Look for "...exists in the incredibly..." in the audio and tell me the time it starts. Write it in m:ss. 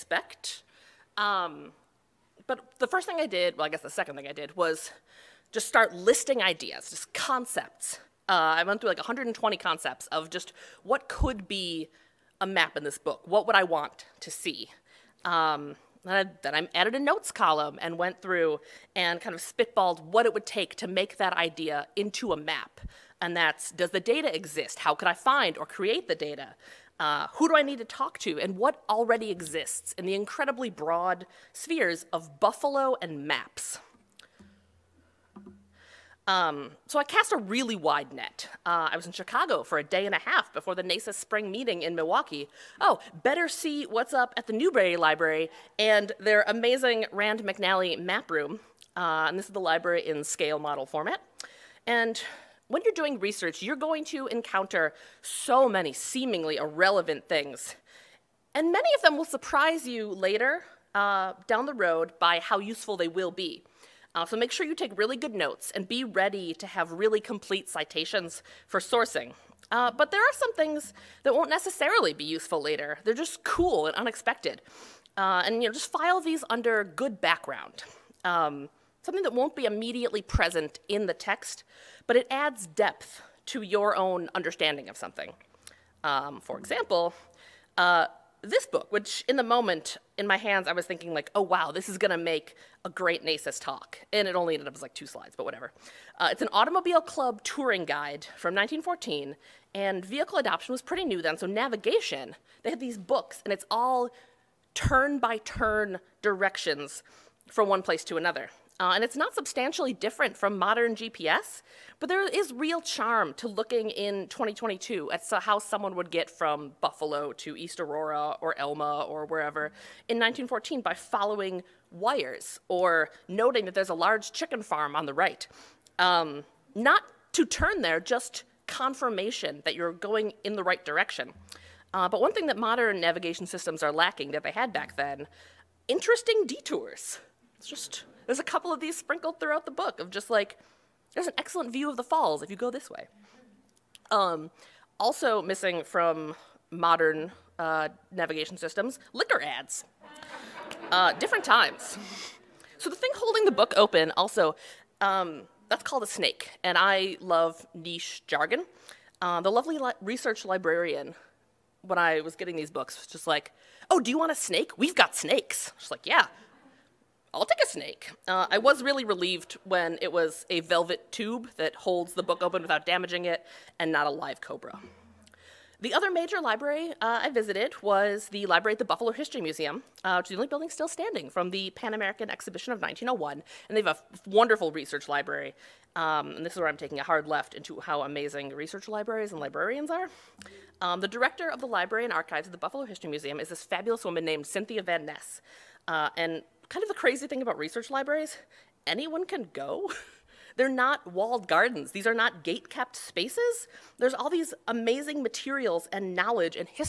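0:29.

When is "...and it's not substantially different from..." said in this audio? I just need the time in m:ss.
1:48.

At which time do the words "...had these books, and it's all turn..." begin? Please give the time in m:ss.
1:42.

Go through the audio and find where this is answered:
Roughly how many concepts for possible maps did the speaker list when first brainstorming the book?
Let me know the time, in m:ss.
0:08.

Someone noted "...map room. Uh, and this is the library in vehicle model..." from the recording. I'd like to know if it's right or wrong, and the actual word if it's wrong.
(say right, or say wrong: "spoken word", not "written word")
wrong: "scale", not "vehicle".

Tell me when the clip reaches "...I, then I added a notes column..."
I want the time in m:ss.
0:16.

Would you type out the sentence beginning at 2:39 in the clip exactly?
Uh, the lovely li research librarian, when I was getting these books, was just like, oh, do you want a snake?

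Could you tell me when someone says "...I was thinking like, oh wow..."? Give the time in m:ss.
1:30.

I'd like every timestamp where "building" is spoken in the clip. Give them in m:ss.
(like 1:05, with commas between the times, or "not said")
3:00.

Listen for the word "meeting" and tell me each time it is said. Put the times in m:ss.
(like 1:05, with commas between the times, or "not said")
0:41.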